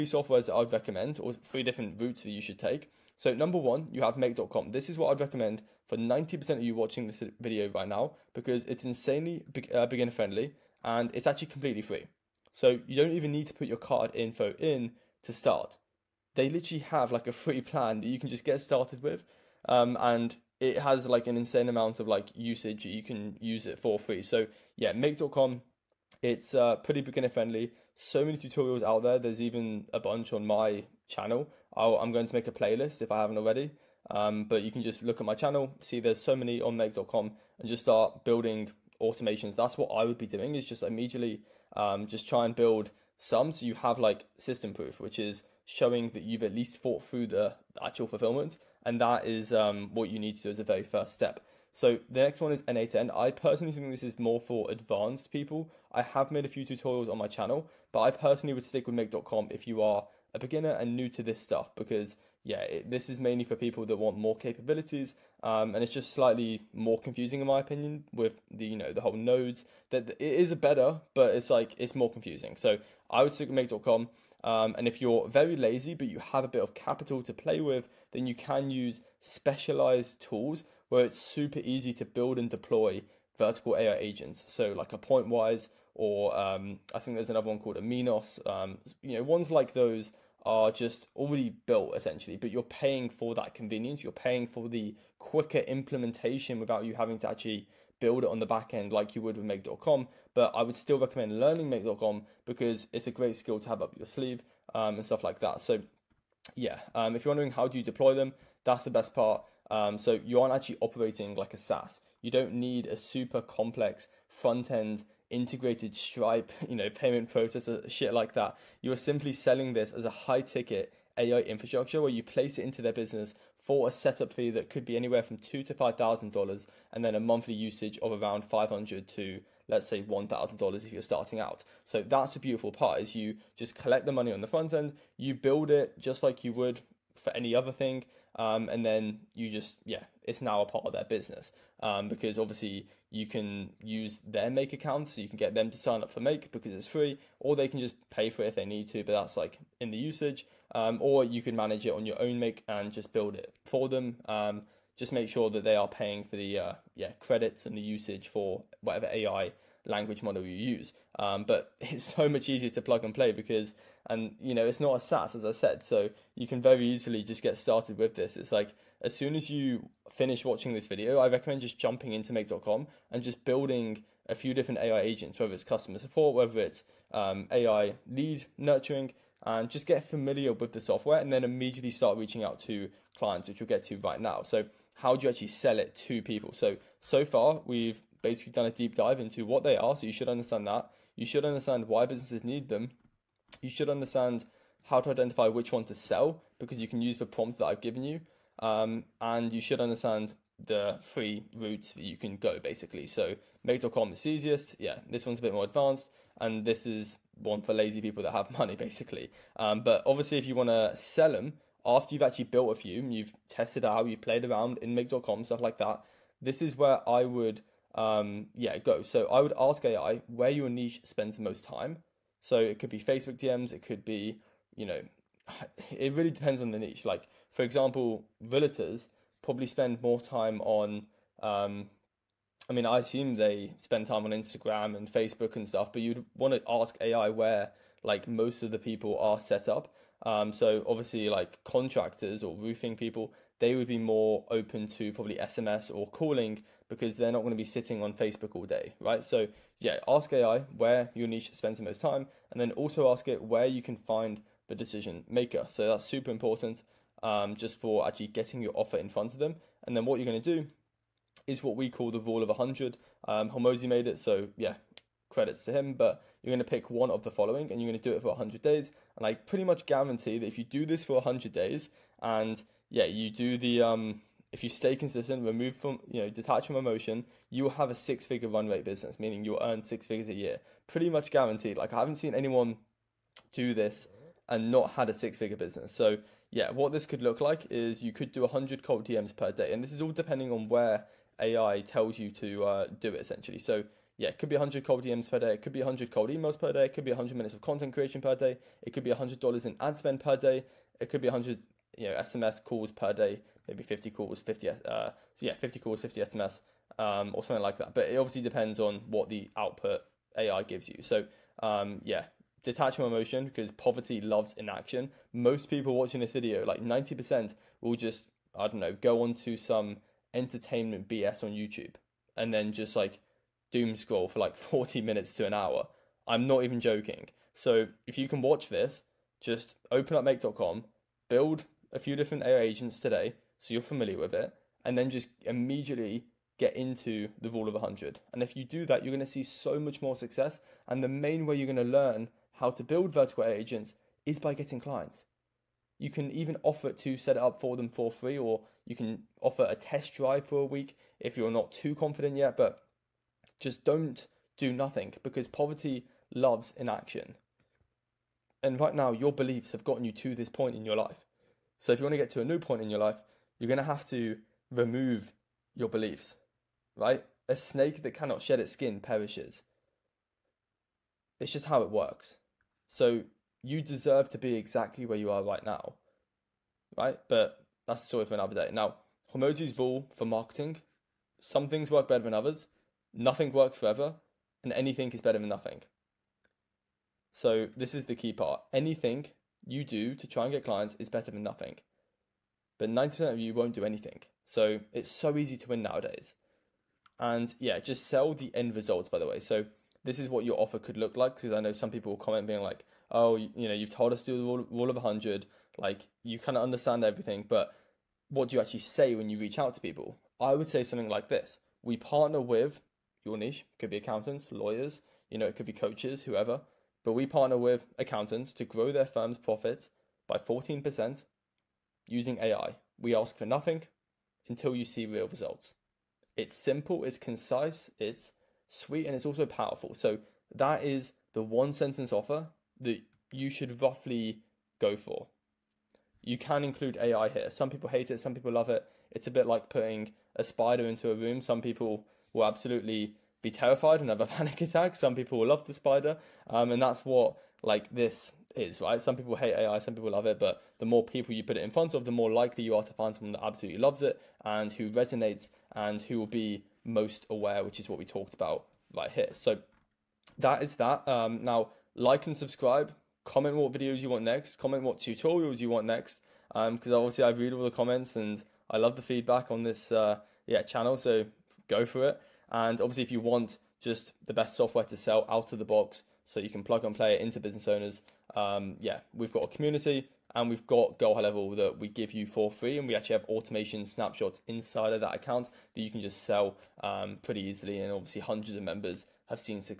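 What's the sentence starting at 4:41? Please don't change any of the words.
Like I haven't seen anyone do this and not had a six figure business.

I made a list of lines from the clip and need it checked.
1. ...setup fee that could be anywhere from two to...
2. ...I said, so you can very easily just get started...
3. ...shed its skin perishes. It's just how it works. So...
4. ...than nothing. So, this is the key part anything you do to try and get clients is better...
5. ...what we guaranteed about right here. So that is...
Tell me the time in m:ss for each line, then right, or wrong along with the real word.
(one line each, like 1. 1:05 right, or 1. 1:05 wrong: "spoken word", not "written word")
1. 2:03 right
2. 2:45 right
3. 6:08 right
4. 6:25 right
5. 7:37 wrong: "talked", not "guaranteed".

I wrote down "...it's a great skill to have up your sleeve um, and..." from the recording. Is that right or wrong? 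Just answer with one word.
right.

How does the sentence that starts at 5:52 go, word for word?
But just don't do nothing because poverty loves inaction.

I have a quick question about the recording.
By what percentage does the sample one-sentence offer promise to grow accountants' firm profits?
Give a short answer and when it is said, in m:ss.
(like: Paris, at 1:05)
14%, at 7:00.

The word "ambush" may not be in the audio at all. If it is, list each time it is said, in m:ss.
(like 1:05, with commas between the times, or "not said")
not said.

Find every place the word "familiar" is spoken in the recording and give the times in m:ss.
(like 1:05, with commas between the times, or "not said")
3:00, 5:33.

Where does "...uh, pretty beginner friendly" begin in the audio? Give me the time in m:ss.
0:26.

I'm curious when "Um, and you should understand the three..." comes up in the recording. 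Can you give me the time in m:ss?
3:18.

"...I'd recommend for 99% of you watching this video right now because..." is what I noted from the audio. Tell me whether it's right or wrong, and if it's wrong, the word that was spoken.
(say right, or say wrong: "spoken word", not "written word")
wrong: "90", not "99".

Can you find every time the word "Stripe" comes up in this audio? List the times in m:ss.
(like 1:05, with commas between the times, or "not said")
1:55.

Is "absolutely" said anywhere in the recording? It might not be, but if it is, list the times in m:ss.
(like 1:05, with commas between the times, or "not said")
7:22, 7:33.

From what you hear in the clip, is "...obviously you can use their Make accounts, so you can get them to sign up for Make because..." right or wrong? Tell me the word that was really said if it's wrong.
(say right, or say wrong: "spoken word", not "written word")
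right.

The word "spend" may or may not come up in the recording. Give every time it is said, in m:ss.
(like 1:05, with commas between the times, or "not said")
3:41, 3:49, 3:53, 4:11, 4:59.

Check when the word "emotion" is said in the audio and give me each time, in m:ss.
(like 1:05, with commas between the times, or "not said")
4:36, 5:13.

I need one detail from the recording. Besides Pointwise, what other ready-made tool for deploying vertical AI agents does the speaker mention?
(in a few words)
Aminos.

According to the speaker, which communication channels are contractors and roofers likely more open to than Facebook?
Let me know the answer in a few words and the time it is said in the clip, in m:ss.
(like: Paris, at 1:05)
SMS or calling, at 4:05.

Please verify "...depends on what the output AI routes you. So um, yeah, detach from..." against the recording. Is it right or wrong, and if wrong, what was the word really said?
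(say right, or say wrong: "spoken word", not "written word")
wrong: "gives", not "routes".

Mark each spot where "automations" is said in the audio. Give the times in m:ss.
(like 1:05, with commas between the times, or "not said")
0:39, 8:03.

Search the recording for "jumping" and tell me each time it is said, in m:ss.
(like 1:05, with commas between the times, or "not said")
2:51.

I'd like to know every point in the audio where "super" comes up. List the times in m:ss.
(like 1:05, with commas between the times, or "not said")
1:21, 1:52, 4:16.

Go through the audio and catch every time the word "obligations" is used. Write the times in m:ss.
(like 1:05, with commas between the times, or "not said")
not said.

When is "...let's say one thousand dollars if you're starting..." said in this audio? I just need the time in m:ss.
2:09.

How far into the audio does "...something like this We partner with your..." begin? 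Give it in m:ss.
6:50.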